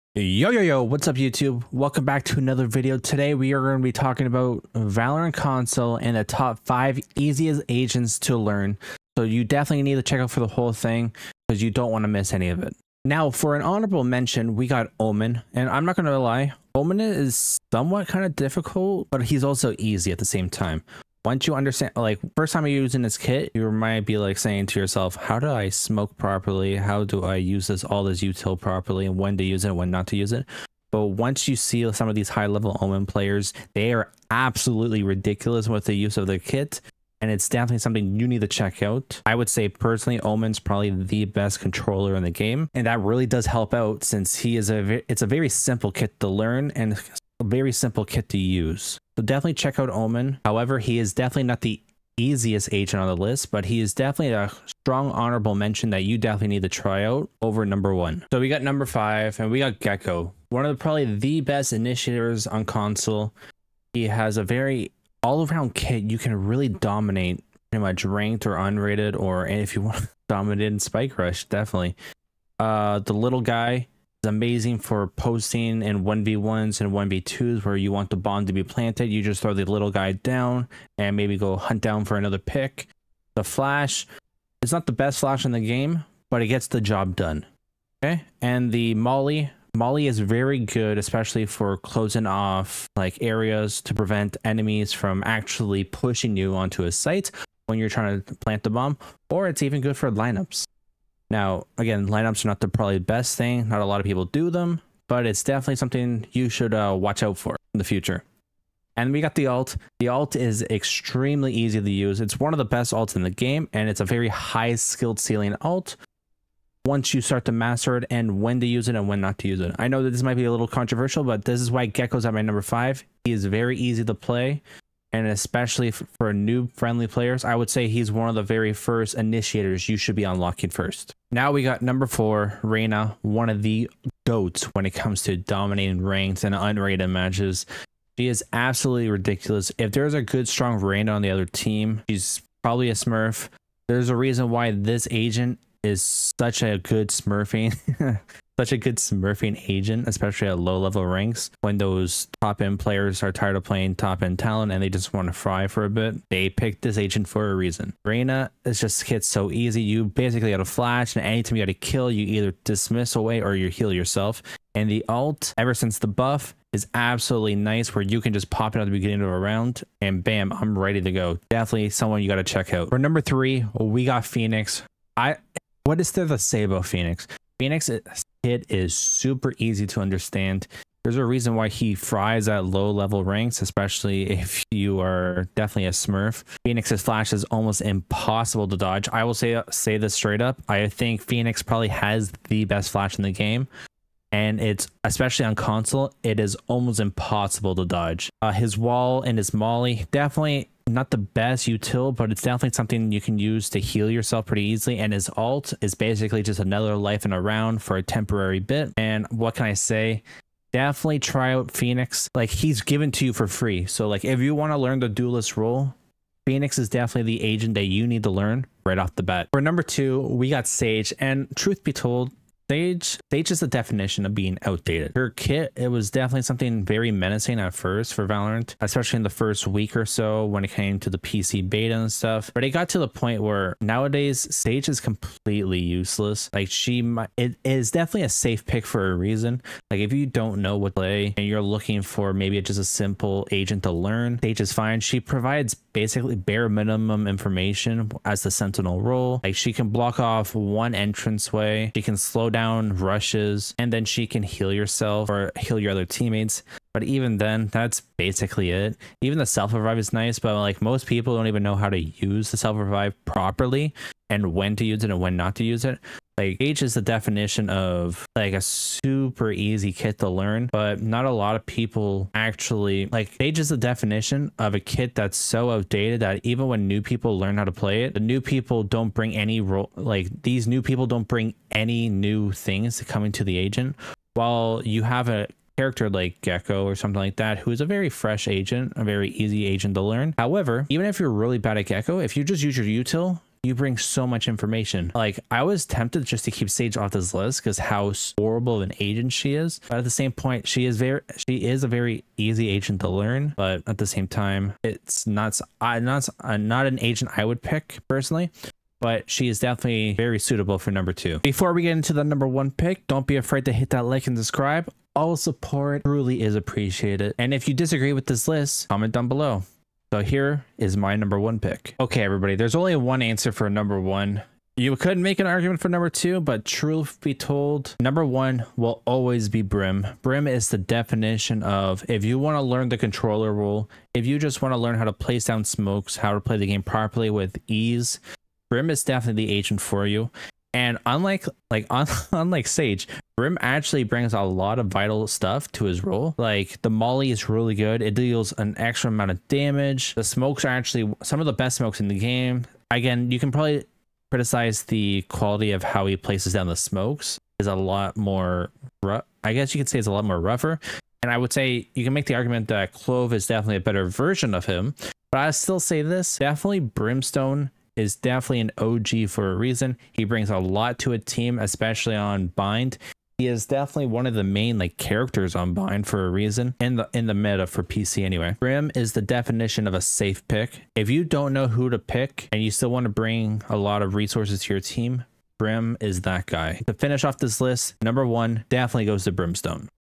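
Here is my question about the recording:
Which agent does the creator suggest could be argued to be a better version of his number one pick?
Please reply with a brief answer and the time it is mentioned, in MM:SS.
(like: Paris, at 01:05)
Clove, at 06:02.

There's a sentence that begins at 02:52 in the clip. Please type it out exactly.
For number three, we got Phoenix.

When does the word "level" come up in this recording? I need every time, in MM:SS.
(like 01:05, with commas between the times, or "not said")
00:32, 02:30, 03:02.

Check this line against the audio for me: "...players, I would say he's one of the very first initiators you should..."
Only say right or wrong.
right.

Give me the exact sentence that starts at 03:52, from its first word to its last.
But it got to the point where nowadays Sage is completely useless.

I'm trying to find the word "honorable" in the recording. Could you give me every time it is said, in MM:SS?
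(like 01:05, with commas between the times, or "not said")
00:13, 00:55.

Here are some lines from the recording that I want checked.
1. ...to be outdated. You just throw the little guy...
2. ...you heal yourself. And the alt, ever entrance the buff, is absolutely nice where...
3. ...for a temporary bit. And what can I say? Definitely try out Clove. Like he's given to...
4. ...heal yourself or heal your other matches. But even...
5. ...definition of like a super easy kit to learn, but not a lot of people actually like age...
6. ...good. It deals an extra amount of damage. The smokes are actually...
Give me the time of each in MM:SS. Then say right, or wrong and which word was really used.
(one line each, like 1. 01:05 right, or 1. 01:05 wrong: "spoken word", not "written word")
1. 01:18 wrong: "planted", not "outdated"
2. 02:43 wrong: "since", not "entrance"
3. 03:27 wrong: "Phoenix", not "Clove"
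4. 04:14 wrong: "teammates", not "matches"
5. 04:27 right
6. 05:47 right.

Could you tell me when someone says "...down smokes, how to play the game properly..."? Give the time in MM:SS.
05:35.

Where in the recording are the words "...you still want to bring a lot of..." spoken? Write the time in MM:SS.
06:22.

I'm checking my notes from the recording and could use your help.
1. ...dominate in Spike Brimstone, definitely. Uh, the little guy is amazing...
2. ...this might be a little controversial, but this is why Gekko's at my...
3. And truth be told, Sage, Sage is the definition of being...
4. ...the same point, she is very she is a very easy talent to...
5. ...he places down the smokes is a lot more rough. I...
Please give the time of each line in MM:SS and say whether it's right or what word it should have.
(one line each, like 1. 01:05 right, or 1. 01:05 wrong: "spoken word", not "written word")
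1. 01:10 wrong: "Rush", not "Brimstone"
2. 02:00 right
3. 03:41 right
4. 05:00 wrong: "agent", not "talent"
5. 05:56 right.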